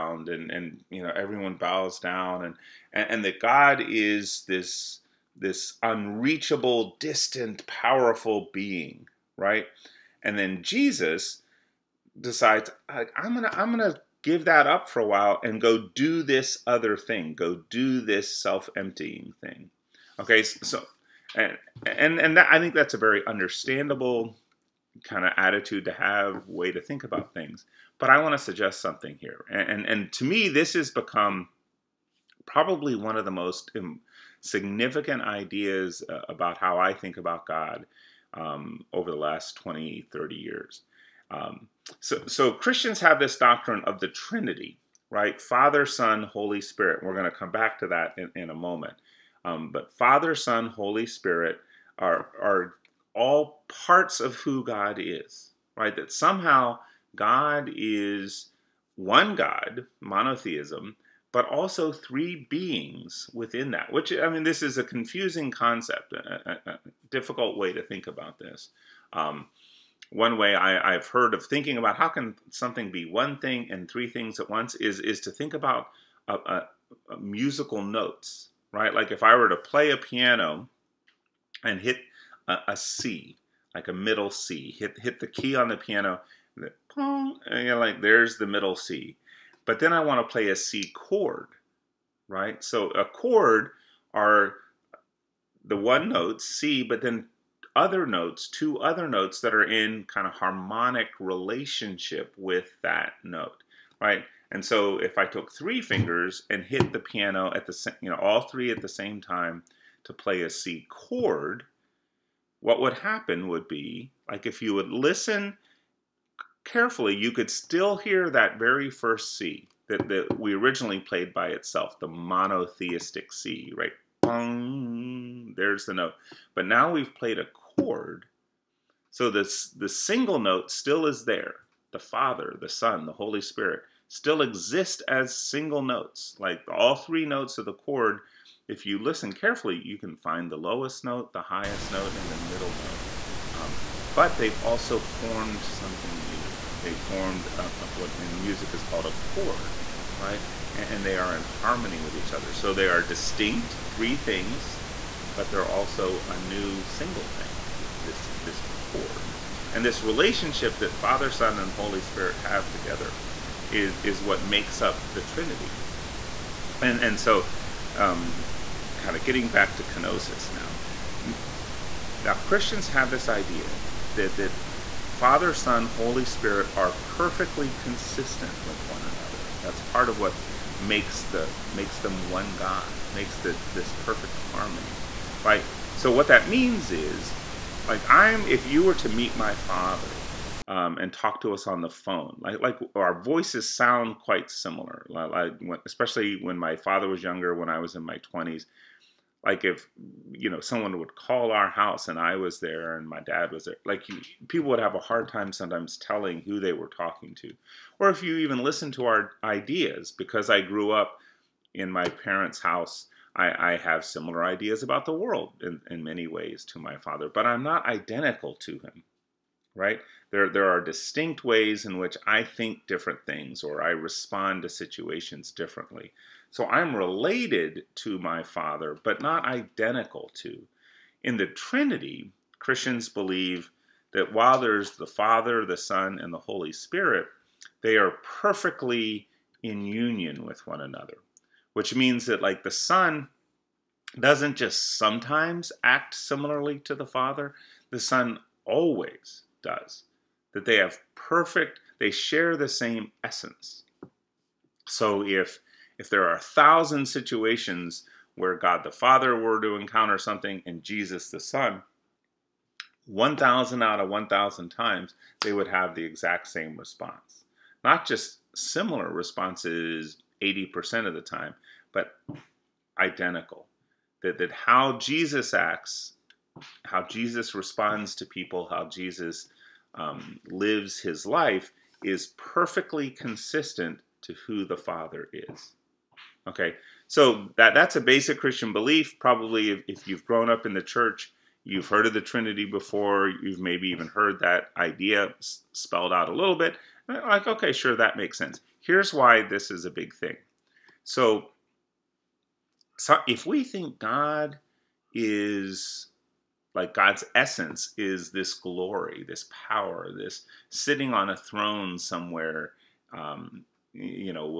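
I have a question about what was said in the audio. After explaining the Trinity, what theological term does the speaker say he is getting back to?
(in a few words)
kenosis.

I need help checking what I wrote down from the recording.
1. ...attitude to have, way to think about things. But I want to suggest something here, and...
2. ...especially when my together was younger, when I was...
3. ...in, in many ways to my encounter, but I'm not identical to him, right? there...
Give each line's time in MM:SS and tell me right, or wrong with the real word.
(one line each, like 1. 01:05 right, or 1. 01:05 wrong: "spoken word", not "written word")
1. 00:25 right
2. 03:15 wrong: "father", not "together"
3. 03:35 wrong: "father", not "encounter".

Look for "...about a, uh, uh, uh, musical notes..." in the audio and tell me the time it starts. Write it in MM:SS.
01:15.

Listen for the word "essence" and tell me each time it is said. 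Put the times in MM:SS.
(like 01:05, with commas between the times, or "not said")
04:13, 05:07.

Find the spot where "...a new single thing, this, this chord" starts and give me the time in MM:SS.
02:36.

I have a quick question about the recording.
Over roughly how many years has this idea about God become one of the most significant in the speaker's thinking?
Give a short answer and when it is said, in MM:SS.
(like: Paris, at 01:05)
20, 30 years, at 00:39.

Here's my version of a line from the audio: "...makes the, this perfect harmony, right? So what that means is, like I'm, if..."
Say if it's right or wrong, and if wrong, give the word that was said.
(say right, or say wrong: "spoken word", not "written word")
right.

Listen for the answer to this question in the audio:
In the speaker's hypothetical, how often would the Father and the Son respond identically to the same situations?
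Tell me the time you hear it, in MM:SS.
04:23.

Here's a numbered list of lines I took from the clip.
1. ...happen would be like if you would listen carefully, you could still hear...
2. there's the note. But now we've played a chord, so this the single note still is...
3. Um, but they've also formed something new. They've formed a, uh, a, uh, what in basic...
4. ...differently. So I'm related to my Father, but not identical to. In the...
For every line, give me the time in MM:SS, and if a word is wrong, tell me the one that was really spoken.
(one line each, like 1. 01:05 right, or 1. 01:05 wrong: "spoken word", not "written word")
1. 01:52 right
2. 02:05 right
3. 02:23 wrong: "music", not "basic"
4. 03:45 right.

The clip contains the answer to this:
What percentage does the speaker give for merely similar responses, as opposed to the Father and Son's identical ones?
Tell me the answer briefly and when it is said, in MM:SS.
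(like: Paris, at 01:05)
80%, at 04:30.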